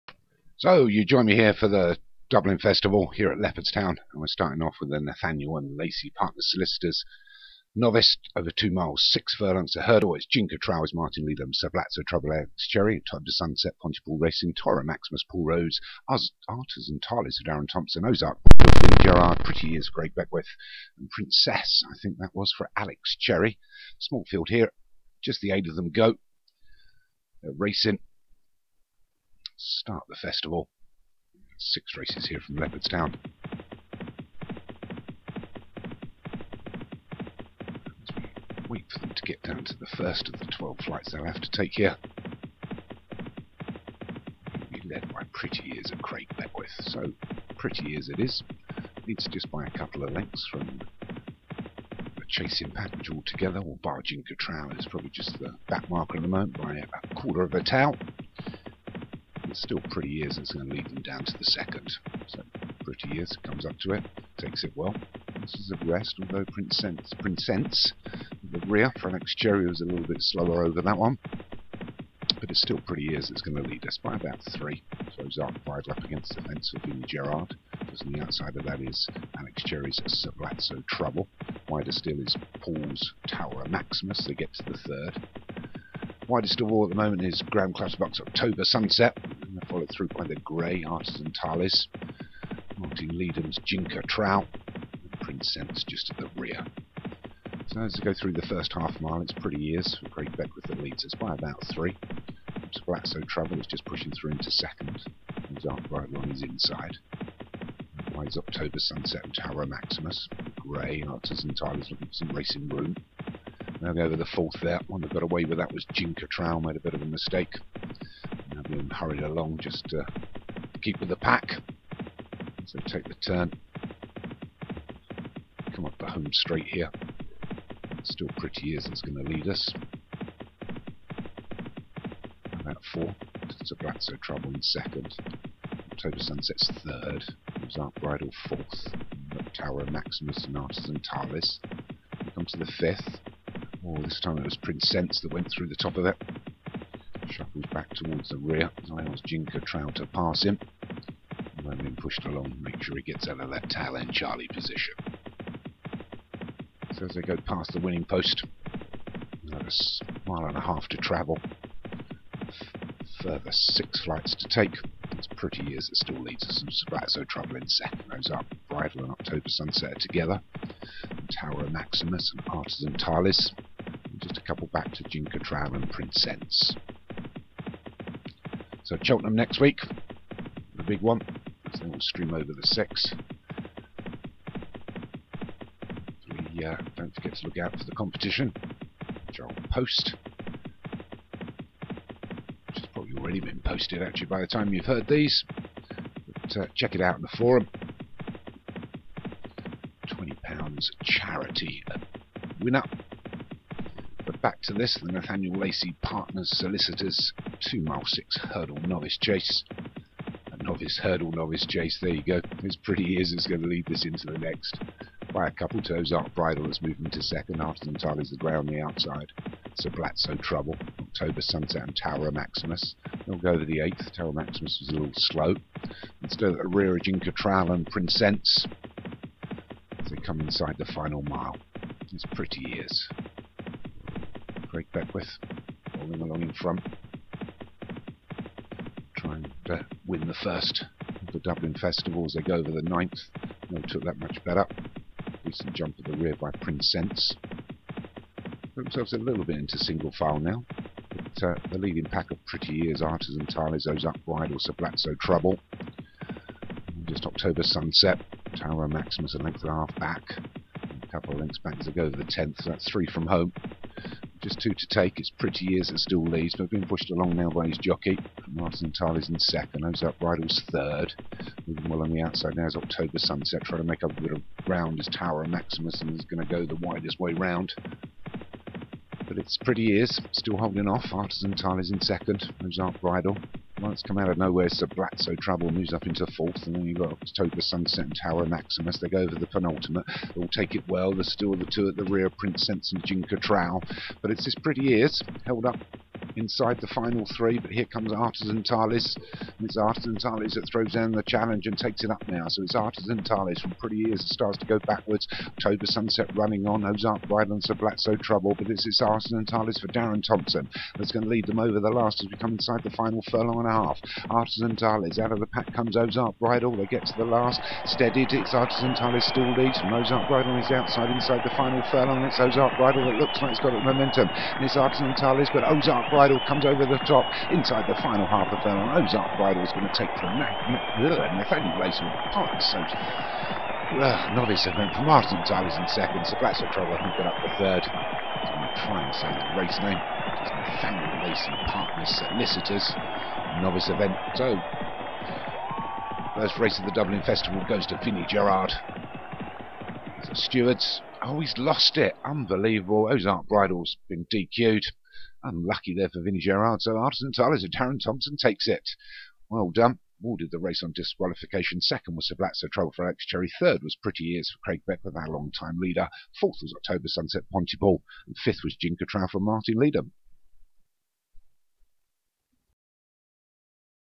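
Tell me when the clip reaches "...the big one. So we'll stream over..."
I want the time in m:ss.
3:00.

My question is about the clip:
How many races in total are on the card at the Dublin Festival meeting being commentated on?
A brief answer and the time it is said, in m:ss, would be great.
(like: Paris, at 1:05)
6, at 0:31.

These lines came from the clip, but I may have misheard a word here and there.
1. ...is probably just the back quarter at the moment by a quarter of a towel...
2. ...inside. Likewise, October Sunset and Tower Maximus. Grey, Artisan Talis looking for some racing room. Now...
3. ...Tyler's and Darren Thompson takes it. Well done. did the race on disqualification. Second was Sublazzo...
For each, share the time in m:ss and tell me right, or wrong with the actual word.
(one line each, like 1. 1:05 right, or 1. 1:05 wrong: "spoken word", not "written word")
1. 0:54 wrong: "marker", not "quarter"
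2. 1:46 right
3. 5:57 right.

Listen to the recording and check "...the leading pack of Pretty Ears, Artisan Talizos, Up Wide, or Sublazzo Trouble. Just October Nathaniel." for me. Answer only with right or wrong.
wrong.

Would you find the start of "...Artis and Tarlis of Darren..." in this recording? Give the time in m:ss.
0:16.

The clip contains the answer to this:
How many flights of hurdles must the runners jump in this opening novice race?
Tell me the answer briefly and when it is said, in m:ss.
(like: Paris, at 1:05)
12, at 0:40.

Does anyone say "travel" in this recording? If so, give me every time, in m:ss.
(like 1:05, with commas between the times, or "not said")
1:43, 2:40.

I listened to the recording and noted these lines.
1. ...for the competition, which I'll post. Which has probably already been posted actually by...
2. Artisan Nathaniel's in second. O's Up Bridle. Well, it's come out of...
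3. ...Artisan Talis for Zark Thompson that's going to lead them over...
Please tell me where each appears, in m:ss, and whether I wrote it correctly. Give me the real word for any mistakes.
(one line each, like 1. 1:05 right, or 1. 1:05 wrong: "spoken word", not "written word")
1. 3:07 right
2. 4:41 wrong: "Talley", not "Nathaniel"
3. 5:09 wrong: "Darren", not "Zark".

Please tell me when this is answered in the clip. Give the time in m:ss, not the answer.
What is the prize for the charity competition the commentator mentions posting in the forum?
3:20.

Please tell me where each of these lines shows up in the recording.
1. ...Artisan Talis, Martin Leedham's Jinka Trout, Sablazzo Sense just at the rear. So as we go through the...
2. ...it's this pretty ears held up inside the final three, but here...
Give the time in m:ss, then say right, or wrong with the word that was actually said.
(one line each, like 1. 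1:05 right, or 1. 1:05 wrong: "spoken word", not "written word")
1. 1:30 wrong: "Prince", not "Sablazzo"
2. 4:54 right.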